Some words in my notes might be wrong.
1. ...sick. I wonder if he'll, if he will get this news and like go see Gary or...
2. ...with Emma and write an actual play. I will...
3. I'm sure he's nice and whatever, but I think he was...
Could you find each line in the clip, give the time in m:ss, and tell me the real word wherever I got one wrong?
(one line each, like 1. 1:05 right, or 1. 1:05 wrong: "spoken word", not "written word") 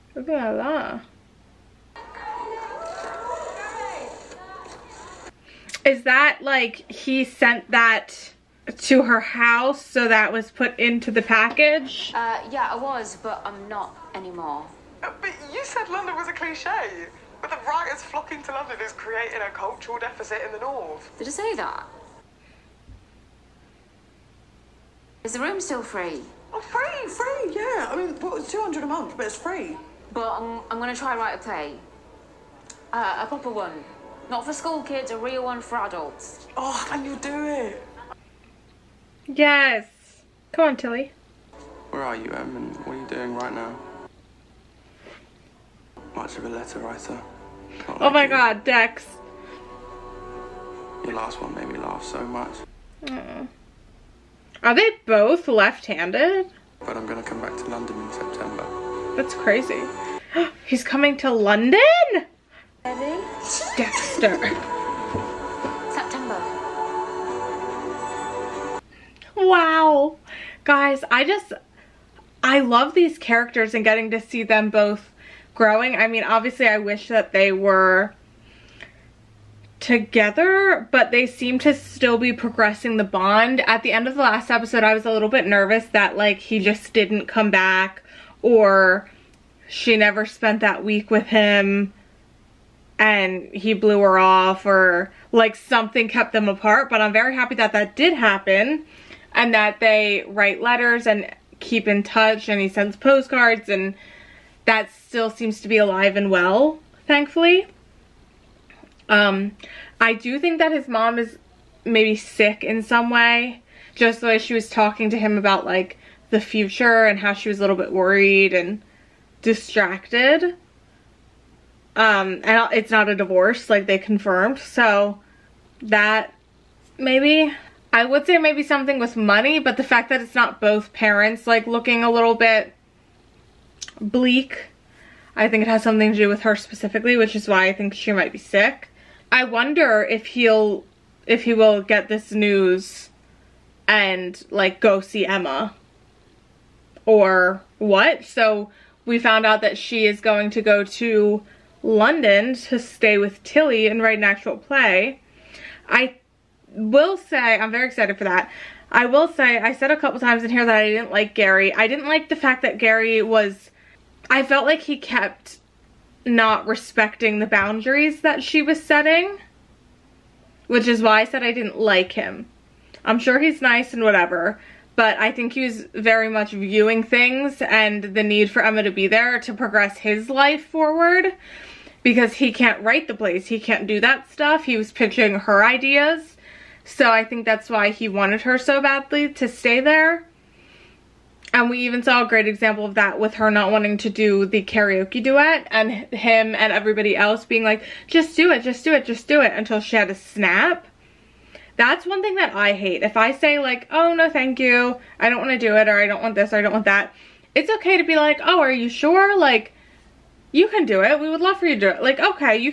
1. 2:18 wrong: "Emma", not "Gary"
2. 2:33 wrong: "Tilly", not "Emma"
3. 2:53 right.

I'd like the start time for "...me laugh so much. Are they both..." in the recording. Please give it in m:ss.
0:51.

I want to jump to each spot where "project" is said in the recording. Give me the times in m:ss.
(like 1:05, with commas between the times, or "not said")
not said.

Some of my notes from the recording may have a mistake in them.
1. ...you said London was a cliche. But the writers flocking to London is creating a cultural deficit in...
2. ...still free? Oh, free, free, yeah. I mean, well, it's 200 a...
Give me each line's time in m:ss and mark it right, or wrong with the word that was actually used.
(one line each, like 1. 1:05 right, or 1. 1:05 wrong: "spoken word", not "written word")
1. 0:15 right
2. 0:25 right.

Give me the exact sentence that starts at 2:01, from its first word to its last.
Um, and it's not a divorce, like they confirmed.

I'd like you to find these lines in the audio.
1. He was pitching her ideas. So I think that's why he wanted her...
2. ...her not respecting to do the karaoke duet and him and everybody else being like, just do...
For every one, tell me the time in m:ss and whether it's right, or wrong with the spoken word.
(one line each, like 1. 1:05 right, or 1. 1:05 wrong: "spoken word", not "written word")
1. 3:04 right
2. 3:13 wrong: "wanting", not "respecting".